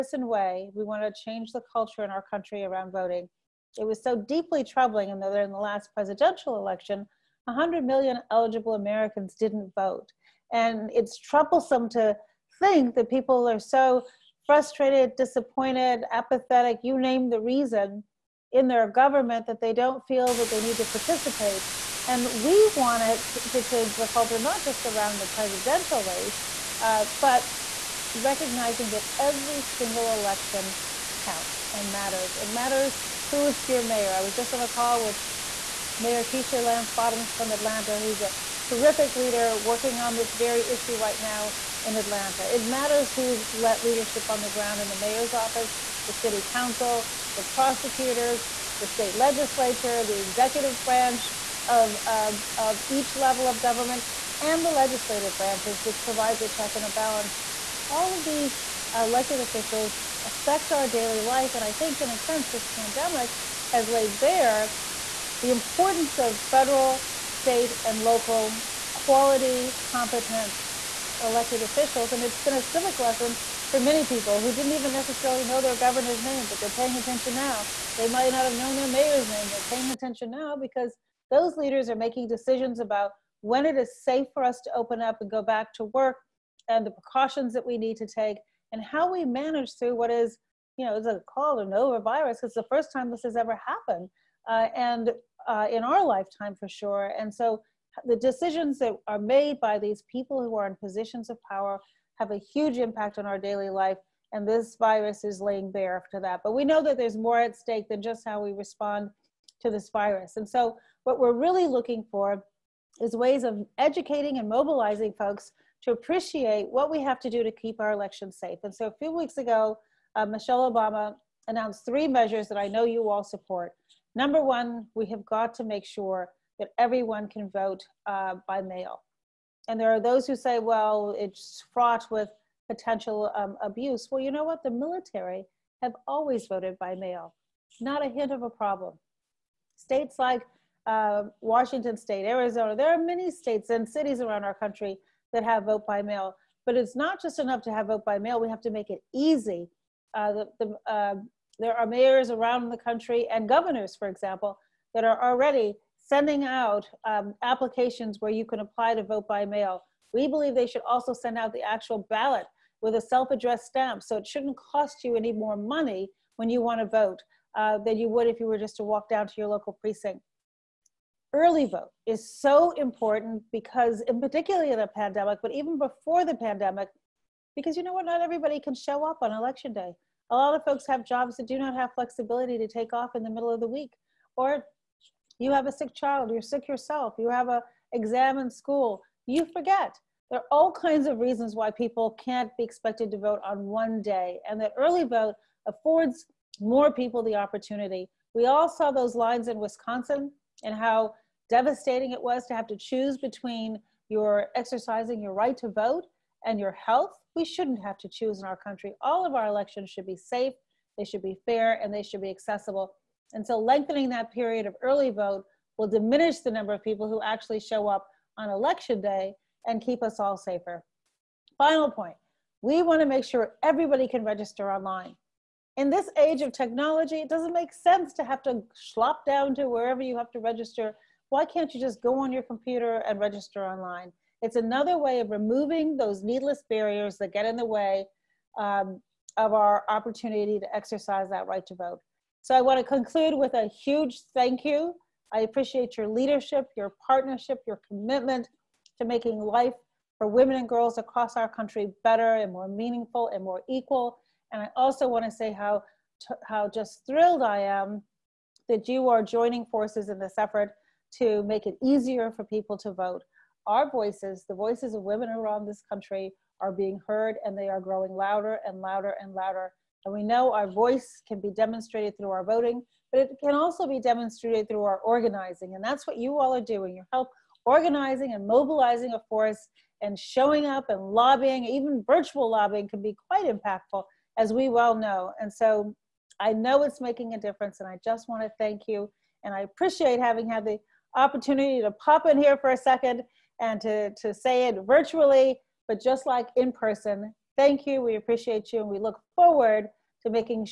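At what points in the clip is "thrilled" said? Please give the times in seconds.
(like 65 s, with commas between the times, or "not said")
257 s.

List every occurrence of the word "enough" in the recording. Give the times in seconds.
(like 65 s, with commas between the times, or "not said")
147 s.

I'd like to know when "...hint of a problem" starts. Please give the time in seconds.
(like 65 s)
138 s.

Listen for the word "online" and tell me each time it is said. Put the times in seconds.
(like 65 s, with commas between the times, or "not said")
224 s, 233 s.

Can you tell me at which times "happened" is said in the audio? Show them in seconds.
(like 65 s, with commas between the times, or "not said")
93 s.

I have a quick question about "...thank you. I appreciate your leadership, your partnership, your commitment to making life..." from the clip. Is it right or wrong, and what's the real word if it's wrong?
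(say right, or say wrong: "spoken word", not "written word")
right.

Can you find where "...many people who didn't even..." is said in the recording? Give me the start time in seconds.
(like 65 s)
73 s.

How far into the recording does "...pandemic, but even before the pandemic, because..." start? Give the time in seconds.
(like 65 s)
174 s.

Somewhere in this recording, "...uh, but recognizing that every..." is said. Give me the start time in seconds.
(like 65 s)
26 s.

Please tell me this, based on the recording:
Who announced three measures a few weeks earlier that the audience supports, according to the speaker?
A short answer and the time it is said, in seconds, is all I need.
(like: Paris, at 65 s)
Michelle Obama, at 120 s.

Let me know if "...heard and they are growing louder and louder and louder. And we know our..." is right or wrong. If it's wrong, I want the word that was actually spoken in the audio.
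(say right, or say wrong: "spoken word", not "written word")
right.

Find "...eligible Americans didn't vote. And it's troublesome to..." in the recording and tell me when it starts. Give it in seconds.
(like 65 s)
8 s.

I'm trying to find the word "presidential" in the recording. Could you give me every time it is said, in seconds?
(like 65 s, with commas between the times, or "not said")
5 s, 25 s.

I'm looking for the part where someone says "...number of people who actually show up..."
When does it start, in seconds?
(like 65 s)
216 s.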